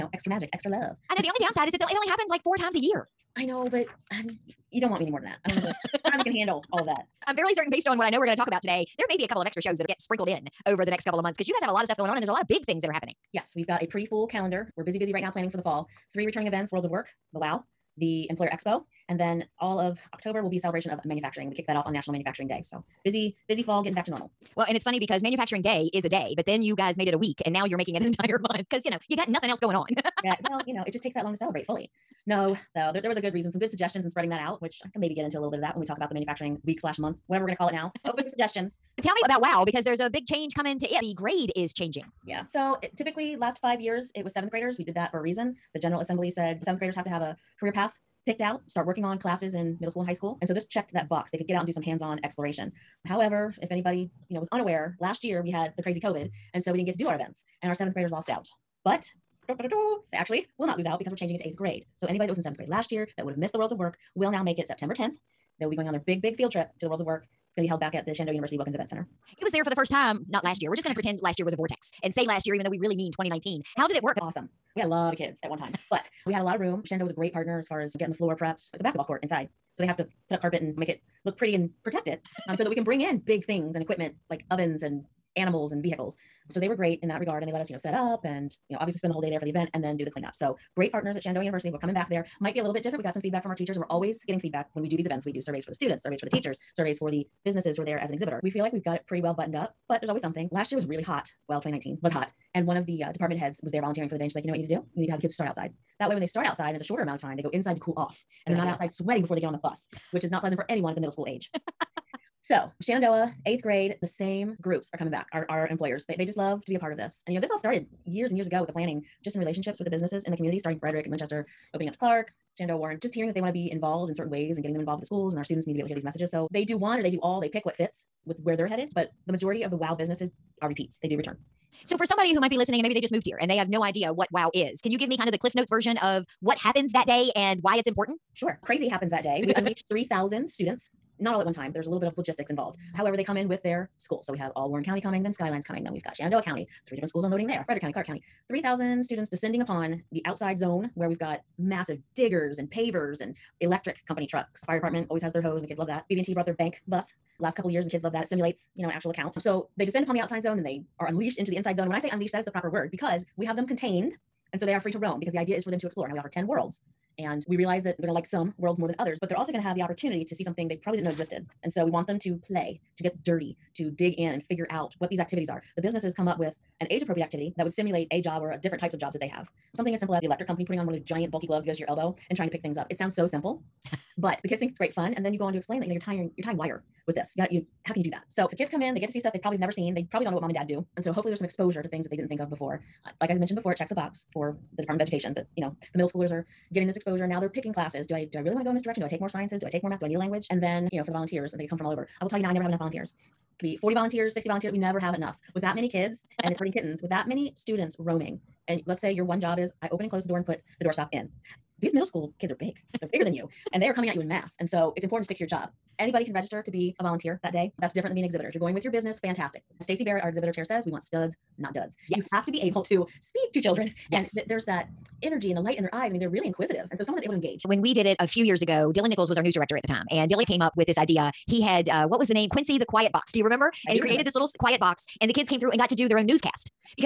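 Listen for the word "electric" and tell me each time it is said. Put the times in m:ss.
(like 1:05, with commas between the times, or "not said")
2:33, 3:00.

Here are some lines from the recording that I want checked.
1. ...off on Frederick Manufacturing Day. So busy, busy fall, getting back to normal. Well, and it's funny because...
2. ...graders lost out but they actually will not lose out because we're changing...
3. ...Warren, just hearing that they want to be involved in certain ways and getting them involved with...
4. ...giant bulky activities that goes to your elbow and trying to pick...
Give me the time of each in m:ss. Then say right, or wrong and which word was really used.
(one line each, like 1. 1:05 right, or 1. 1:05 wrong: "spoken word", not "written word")
1. 0:21 wrong: "National", not "Frederick"
2. 0:57 right
3. 2:02 right
4. 3:01 wrong: "gloves", not "activities".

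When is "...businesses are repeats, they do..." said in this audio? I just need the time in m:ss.
2:09.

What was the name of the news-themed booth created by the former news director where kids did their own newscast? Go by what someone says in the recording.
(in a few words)
Quincy the Quiet Box.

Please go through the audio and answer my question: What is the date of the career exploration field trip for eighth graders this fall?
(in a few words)
September 10th.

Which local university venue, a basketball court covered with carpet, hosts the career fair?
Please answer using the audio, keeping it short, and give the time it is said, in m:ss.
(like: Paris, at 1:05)
Wilkins Event Center, at 1:08.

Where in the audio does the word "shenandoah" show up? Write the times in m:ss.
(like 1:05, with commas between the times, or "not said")
1:08, 1:16, 1:31, 1:52, 2:02, 2:26.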